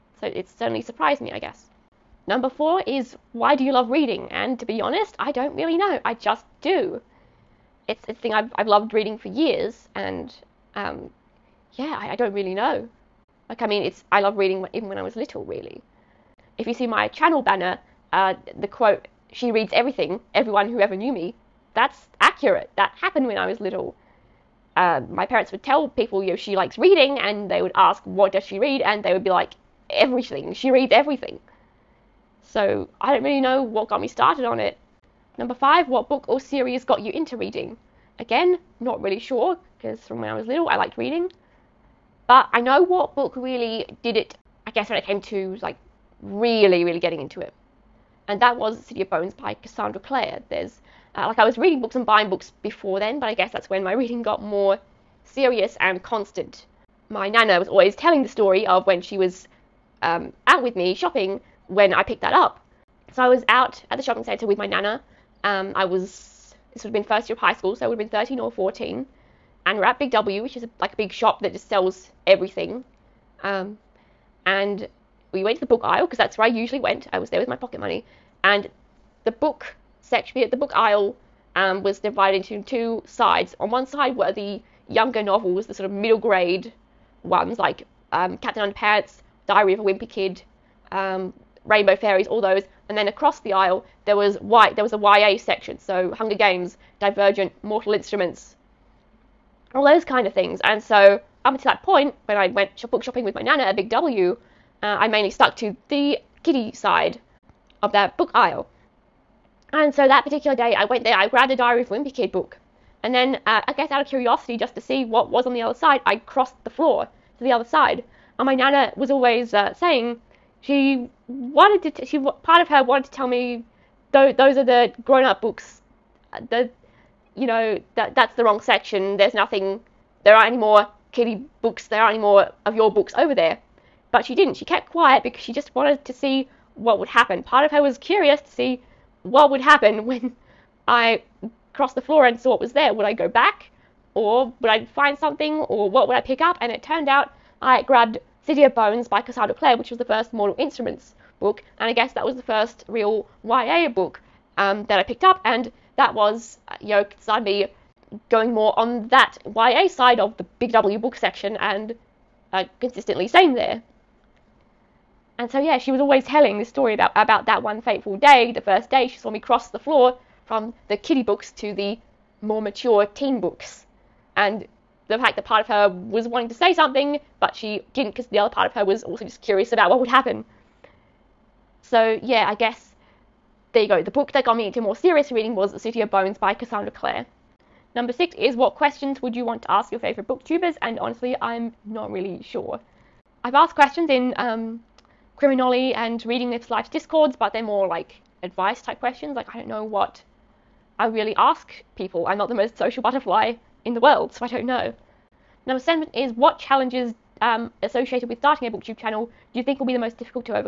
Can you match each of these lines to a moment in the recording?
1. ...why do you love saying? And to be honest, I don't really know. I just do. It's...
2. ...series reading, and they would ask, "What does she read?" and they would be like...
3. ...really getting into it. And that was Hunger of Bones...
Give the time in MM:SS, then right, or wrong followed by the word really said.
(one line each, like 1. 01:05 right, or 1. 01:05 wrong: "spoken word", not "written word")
1. 00:03 wrong: "reading", not "saying"
2. 00:26 wrong: "likes", not "series"
3. 00:46 wrong: "City", not "Hunger".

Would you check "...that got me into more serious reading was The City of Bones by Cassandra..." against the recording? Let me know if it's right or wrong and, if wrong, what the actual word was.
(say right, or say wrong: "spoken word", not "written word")
right.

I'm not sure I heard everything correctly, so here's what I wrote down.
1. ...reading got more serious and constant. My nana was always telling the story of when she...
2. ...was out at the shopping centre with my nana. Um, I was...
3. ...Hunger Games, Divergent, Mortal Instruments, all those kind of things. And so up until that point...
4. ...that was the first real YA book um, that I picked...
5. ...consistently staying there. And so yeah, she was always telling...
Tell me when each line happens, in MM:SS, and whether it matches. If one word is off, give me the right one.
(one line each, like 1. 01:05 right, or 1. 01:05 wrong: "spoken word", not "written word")
1. 00:54 right
2. 01:03 right
3. 01:36 right
4. 02:32 right
5. 02:42 right.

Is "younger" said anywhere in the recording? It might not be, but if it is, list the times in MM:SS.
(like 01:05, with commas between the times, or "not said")
01:24.